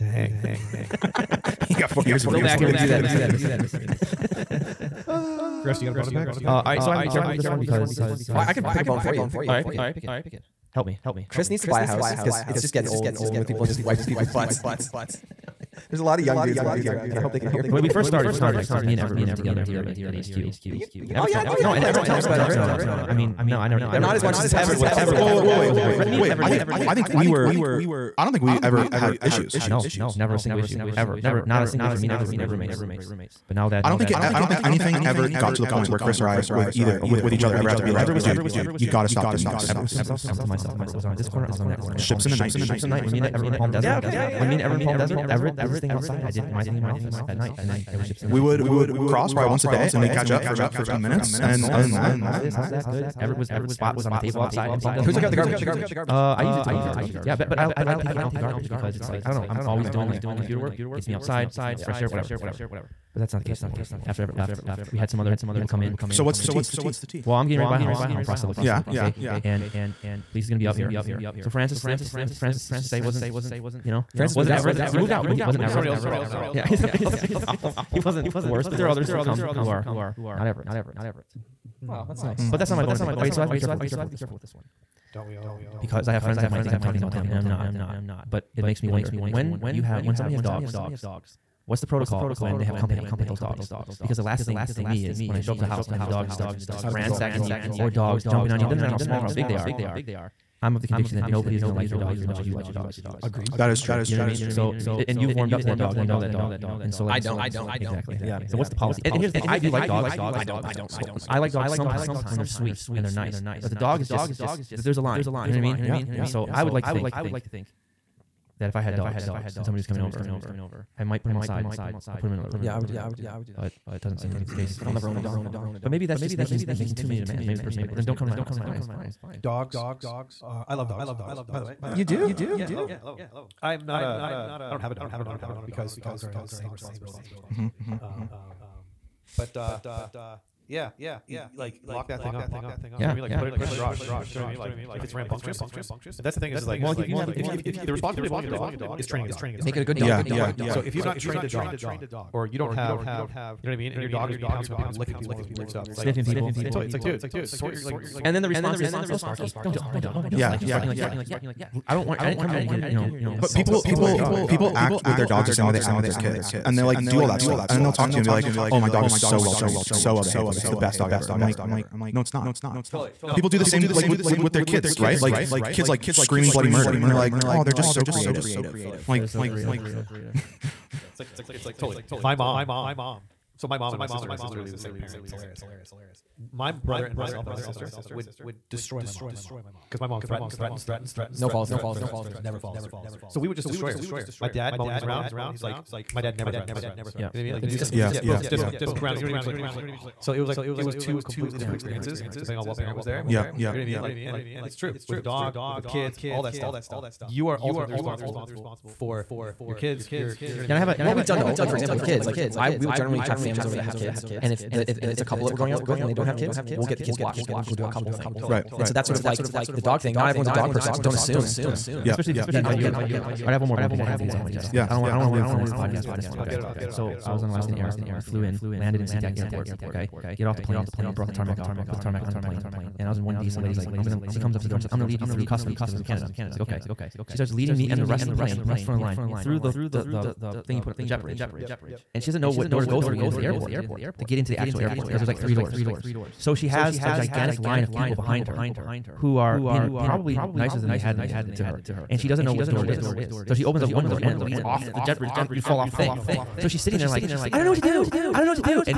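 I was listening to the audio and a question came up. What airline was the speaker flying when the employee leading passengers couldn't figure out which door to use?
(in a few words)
Alaskan Air.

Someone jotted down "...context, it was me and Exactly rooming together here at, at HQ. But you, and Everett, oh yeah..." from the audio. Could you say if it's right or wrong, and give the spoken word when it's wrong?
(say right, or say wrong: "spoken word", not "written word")
wrong: "Everett", not "Exactly".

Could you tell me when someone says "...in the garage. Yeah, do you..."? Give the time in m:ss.
2:23.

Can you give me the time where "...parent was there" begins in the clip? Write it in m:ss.
3:22.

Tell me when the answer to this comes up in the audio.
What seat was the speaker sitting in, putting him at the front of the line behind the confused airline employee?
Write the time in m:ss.
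3:53.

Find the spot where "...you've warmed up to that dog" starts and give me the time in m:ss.
1:45.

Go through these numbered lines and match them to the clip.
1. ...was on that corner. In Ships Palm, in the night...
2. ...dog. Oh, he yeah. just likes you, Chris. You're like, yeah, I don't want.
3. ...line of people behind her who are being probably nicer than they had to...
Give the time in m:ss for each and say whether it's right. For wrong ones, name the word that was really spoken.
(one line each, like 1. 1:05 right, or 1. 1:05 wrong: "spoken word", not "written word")
1. 0:41 right
2. 2:39 wrong: "Sparky", not "Chris"
3. 4:07 right.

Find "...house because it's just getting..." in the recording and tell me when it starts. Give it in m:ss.
0:11.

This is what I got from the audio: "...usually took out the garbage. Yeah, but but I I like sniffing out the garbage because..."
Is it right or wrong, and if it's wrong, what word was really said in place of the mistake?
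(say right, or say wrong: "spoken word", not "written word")
wrong: "taking", not "sniffing".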